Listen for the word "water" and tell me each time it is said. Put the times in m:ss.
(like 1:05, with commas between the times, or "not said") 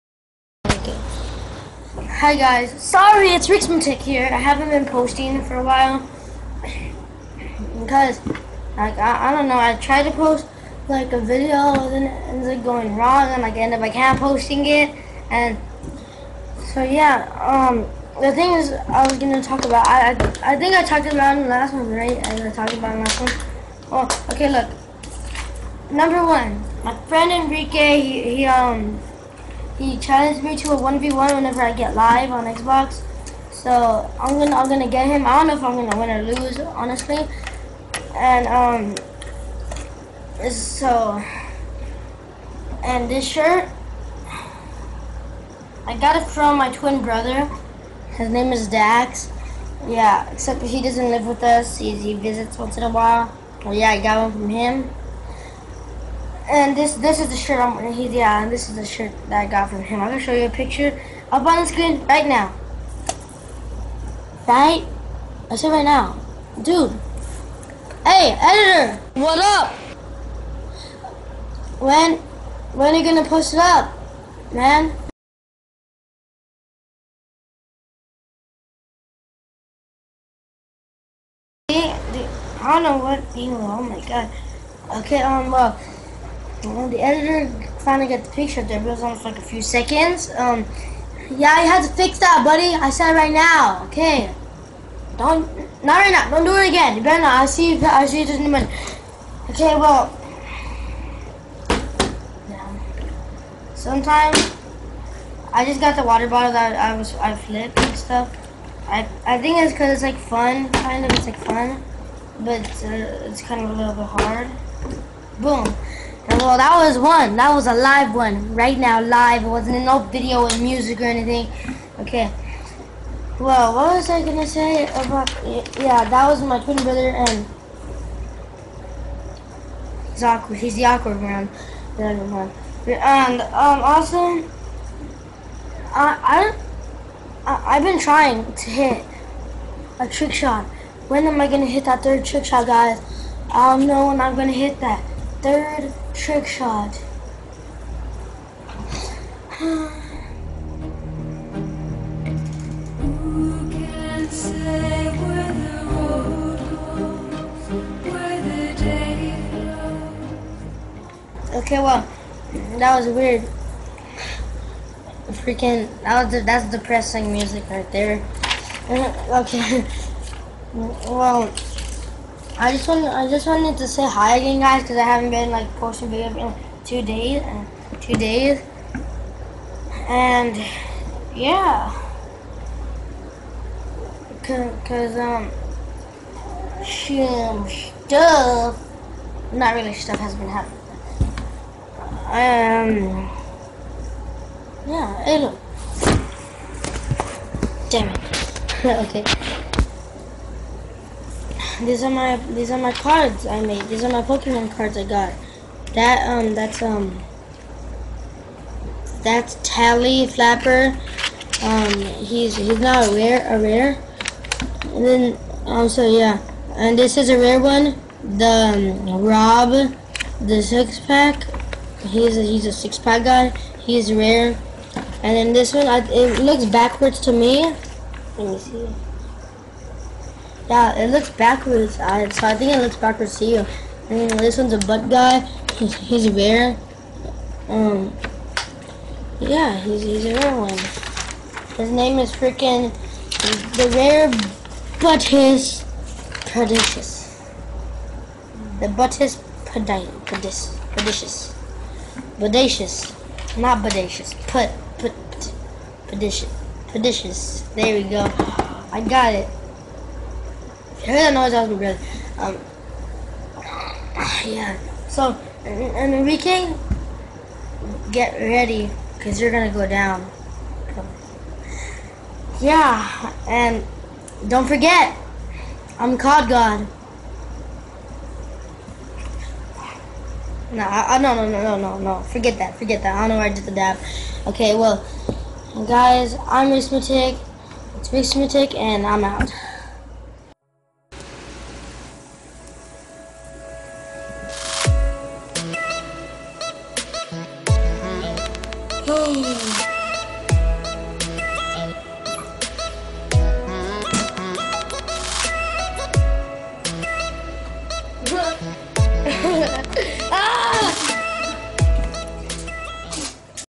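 1:46.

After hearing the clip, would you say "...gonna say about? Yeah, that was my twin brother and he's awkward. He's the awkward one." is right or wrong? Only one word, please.
right.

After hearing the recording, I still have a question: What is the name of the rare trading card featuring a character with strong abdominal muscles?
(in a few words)
Rob the six pack.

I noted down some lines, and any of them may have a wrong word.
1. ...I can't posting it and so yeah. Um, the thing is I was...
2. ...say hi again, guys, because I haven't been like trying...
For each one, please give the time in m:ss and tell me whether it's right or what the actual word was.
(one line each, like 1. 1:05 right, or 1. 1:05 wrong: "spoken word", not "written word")
1. 0:13 right
2. 2:53 wrong: "posting", not "trying".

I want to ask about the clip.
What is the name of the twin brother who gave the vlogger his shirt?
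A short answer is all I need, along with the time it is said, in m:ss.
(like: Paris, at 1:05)
Dax, at 0:48.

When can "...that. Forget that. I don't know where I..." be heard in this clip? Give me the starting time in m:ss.
4:42.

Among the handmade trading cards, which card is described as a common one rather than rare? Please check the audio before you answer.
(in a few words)
Tally Flapper.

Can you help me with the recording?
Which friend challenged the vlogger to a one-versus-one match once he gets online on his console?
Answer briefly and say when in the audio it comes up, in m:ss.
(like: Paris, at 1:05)
Enrique, at 0:27.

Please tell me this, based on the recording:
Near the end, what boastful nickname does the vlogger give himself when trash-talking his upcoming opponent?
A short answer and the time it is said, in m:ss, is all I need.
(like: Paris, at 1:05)
COD God, at 4:36.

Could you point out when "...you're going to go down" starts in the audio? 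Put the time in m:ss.
4:29.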